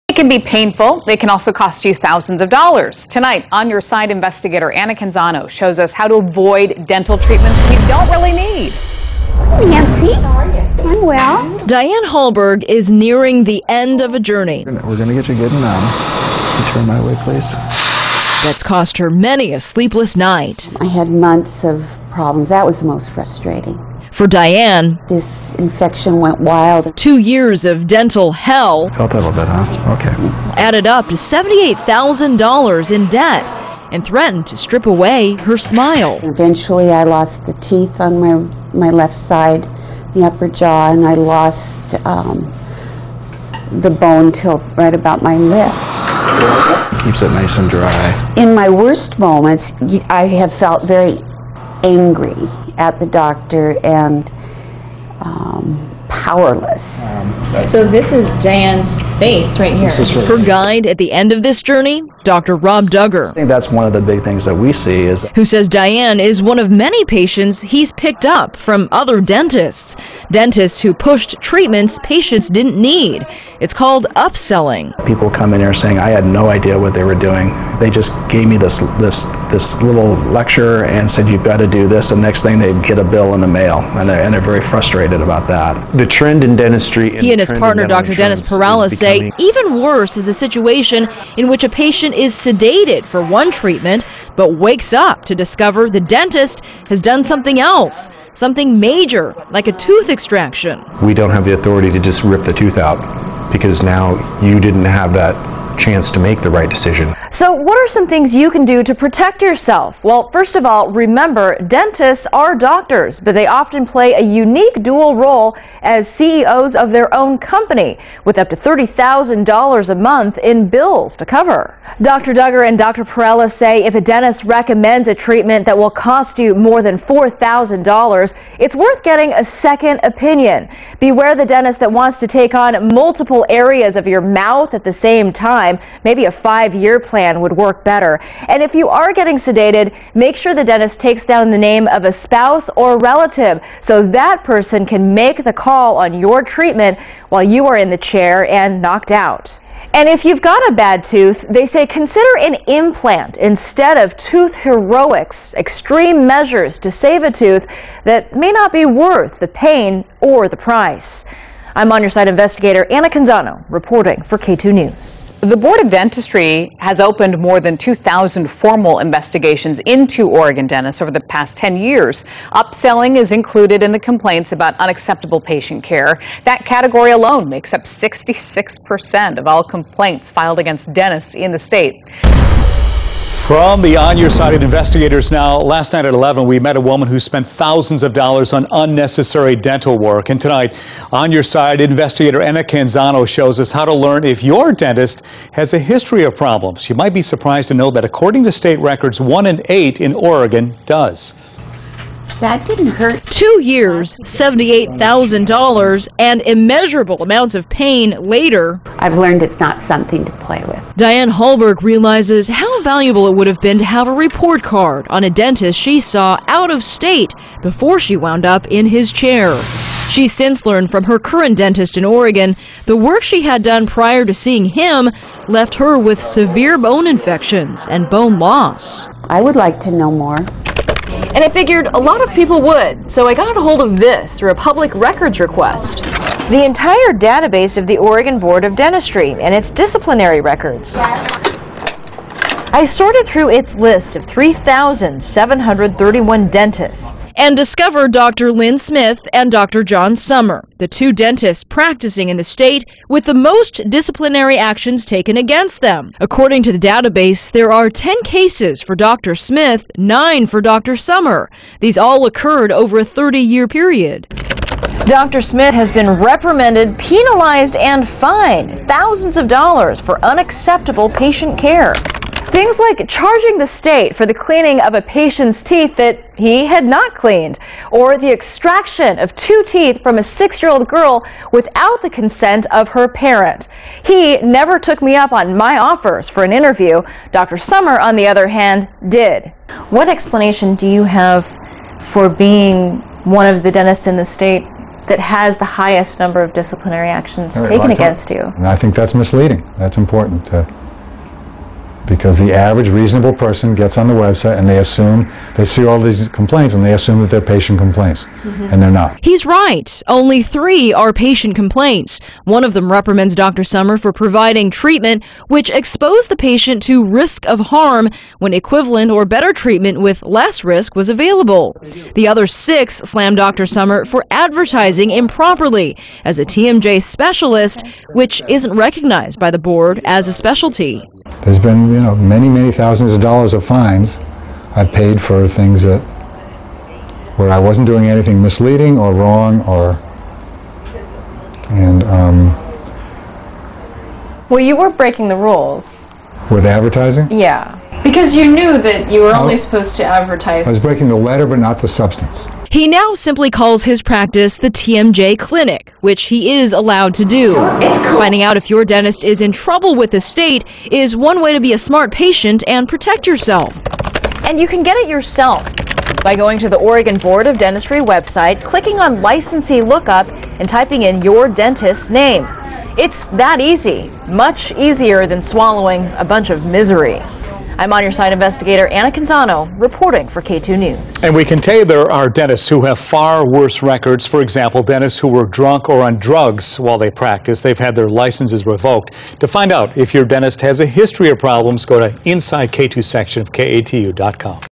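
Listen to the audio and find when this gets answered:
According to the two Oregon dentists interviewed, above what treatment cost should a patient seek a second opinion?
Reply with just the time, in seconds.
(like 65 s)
126 s.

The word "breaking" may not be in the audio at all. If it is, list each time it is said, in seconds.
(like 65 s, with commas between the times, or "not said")
344 s, 350 s.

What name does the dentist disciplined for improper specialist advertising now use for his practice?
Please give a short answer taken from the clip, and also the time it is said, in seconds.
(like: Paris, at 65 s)
the TMJ Clinic, at 354 s.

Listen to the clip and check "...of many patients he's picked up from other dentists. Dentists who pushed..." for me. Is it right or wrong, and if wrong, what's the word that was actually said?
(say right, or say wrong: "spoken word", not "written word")
right.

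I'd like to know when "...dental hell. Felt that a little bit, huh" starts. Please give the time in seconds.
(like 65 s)
27 s.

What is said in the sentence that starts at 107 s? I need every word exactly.
So what are some things you can do to protect yourself?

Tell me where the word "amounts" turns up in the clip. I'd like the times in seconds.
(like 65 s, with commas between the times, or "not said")
207 s.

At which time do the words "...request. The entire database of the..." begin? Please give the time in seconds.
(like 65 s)
235 s.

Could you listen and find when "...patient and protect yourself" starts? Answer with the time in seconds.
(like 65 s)
362 s.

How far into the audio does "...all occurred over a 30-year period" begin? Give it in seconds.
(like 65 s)
261 s.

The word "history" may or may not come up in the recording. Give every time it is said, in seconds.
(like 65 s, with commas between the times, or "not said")
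195 s, 390 s.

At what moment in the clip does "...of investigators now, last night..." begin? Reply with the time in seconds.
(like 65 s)
184 s.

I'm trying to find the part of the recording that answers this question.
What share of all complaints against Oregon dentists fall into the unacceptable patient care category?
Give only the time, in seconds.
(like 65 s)
177 s.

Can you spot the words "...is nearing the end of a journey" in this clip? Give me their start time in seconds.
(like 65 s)
12 s.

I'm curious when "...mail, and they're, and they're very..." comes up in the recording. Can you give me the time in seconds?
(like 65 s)
83 s.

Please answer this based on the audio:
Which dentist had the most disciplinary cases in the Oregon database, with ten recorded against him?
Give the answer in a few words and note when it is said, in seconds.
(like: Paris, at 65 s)
Dr. Lynn Smith, at 248 s.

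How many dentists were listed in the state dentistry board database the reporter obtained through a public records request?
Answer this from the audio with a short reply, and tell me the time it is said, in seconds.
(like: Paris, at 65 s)
3,731, at 244 s.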